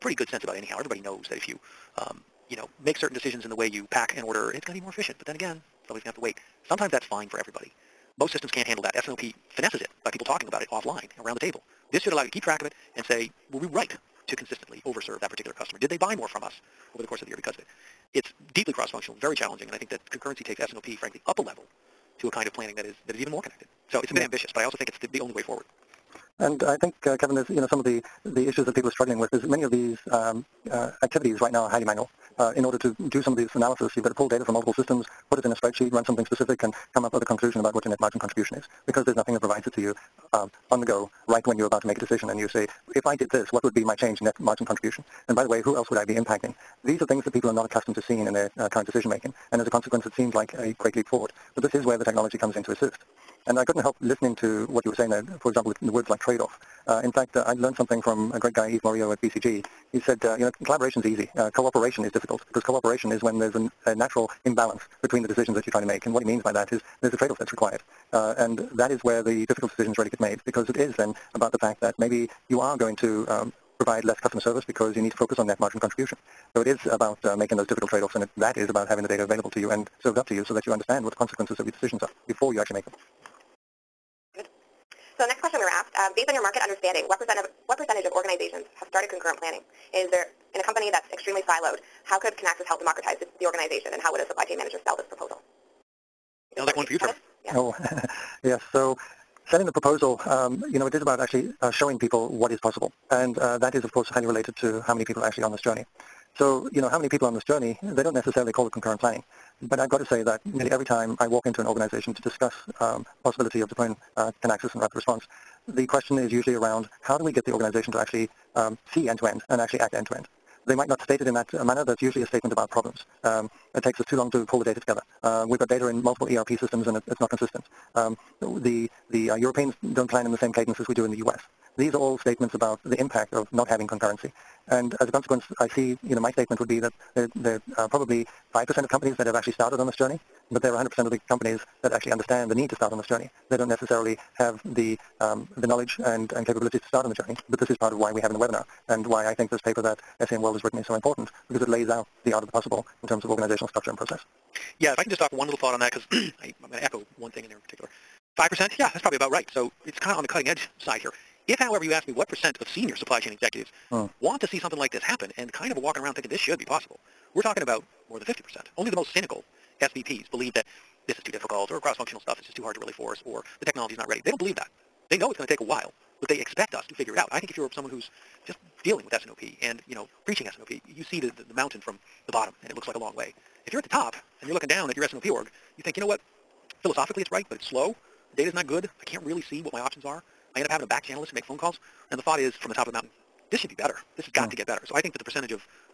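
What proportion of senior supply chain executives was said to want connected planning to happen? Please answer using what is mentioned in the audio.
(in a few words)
more than 50%.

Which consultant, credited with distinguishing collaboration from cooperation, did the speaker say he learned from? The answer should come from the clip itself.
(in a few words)
Yves Morieux.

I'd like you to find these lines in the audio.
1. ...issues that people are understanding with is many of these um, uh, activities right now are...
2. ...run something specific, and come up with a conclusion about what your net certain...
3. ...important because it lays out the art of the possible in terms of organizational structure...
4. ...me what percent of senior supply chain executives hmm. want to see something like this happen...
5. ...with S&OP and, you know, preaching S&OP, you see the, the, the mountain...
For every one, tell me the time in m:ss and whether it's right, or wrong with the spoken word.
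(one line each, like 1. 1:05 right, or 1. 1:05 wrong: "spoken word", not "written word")
1. 0:28 wrong: "struggling", not "understanding"
2. 0:35 wrong: "margin", not "certain"
3. 2:30 right
4. 2:42 right
5. 2:59 right.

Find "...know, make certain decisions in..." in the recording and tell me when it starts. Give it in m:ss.
0:02.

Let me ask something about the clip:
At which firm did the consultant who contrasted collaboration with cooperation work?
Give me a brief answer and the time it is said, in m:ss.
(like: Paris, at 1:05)
BCG, at 0:59.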